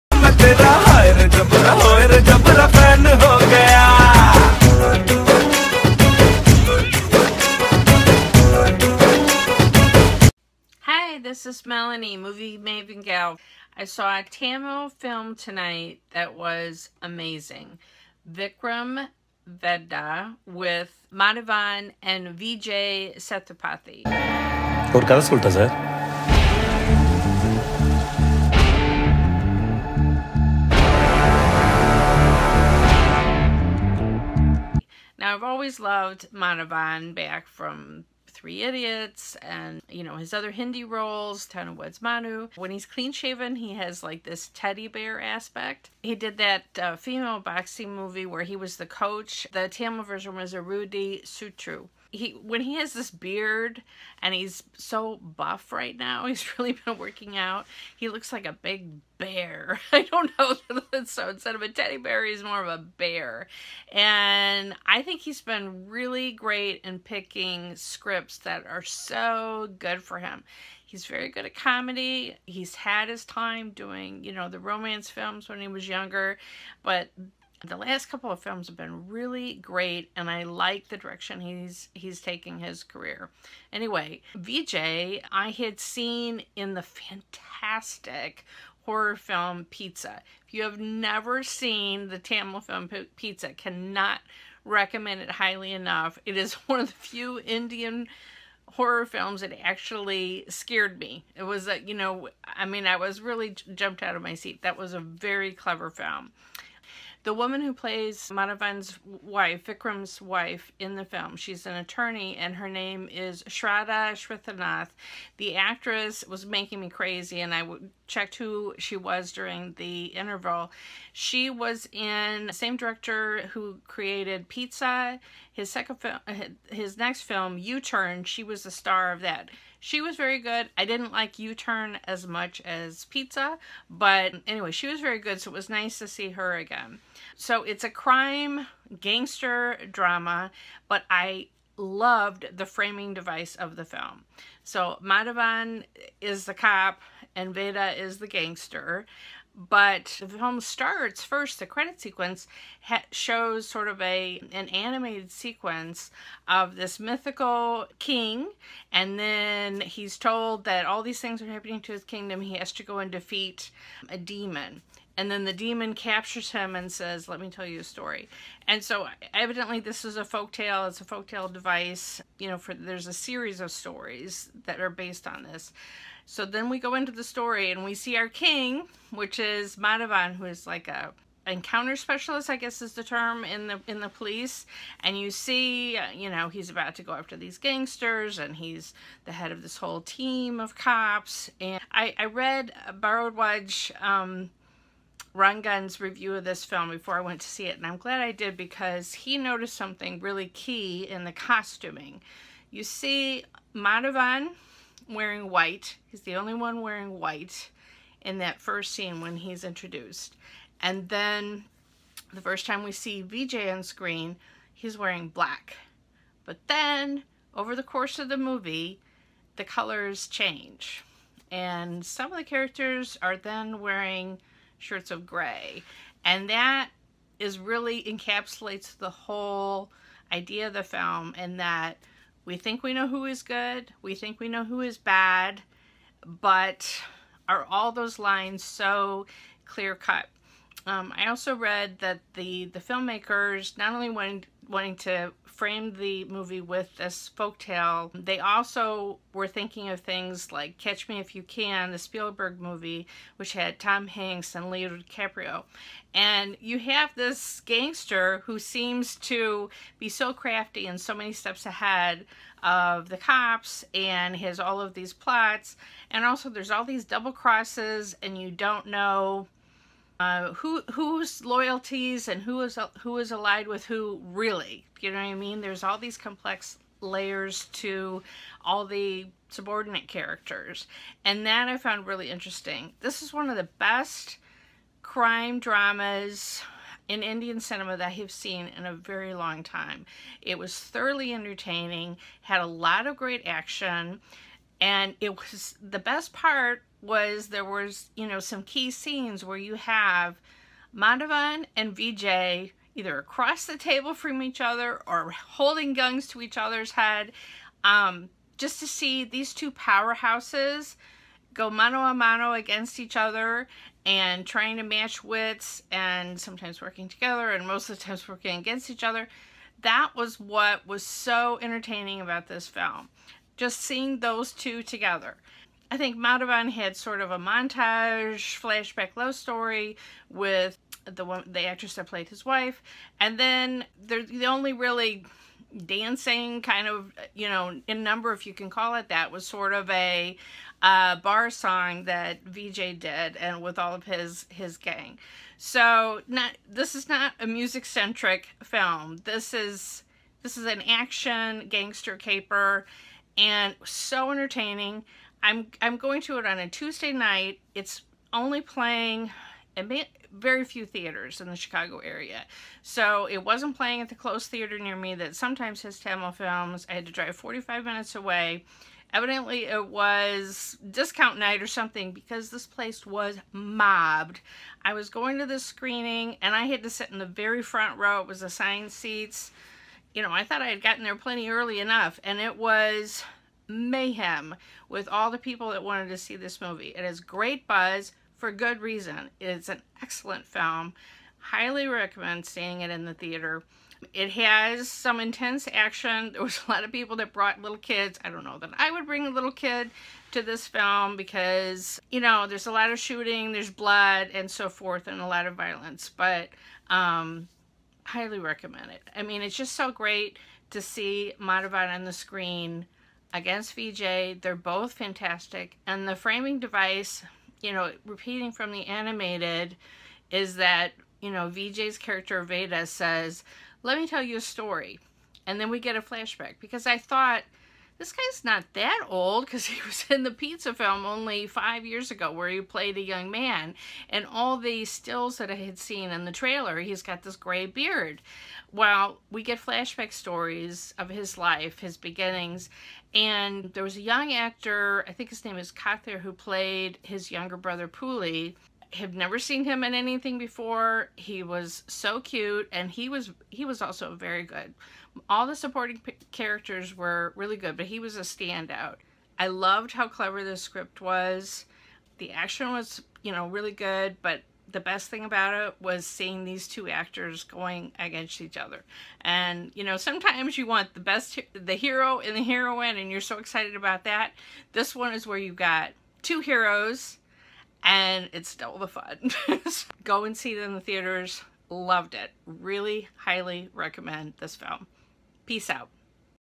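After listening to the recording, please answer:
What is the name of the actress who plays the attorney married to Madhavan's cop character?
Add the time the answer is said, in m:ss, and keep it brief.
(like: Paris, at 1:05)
Shraddha Shrithanath, at 1:53.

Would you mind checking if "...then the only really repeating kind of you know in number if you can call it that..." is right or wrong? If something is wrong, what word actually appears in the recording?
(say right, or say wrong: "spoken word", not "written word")
wrong: "dancing", not "repeating".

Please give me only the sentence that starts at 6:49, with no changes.
I mean, it's just so great to see Madhavan on the screen against VJ.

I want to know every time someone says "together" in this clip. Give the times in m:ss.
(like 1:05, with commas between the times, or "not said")
5:17, 5:24.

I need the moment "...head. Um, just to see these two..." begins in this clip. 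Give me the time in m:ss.
5:06.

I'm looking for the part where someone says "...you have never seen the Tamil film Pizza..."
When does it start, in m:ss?
1:30.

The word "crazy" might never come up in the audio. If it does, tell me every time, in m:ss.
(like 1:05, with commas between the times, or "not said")
1:56.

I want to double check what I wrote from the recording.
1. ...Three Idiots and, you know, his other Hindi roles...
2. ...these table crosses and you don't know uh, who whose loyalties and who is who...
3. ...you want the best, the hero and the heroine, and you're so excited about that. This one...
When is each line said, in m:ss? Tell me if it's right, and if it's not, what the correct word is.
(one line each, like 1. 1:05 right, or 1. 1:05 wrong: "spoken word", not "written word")
1. 0:38 right
2. 4:26 wrong: "double", not "table"
3. 7:50 right.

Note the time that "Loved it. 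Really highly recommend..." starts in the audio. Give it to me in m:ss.
8:01.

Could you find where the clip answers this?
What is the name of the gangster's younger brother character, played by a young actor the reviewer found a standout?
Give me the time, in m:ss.
7:27.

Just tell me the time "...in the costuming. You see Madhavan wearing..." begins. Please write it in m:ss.
3:21.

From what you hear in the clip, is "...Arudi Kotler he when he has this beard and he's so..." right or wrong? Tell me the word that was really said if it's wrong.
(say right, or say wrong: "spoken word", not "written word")
wrong: "Sutru", not "Kotler".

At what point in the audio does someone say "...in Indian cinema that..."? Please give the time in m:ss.
4:47.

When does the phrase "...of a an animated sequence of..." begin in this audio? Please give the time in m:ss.
2:33.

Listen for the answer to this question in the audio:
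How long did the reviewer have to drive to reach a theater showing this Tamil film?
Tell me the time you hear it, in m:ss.
6:07.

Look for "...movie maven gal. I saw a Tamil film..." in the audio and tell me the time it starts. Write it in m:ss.
0:12.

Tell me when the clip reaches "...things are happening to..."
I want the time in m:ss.
2:41.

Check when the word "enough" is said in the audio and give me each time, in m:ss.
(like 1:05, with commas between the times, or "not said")
1:35, 6:21.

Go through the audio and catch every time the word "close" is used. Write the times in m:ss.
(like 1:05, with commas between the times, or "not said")
6:04.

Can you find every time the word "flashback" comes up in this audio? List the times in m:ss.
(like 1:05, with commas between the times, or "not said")
5:28, 7:06, 7:19.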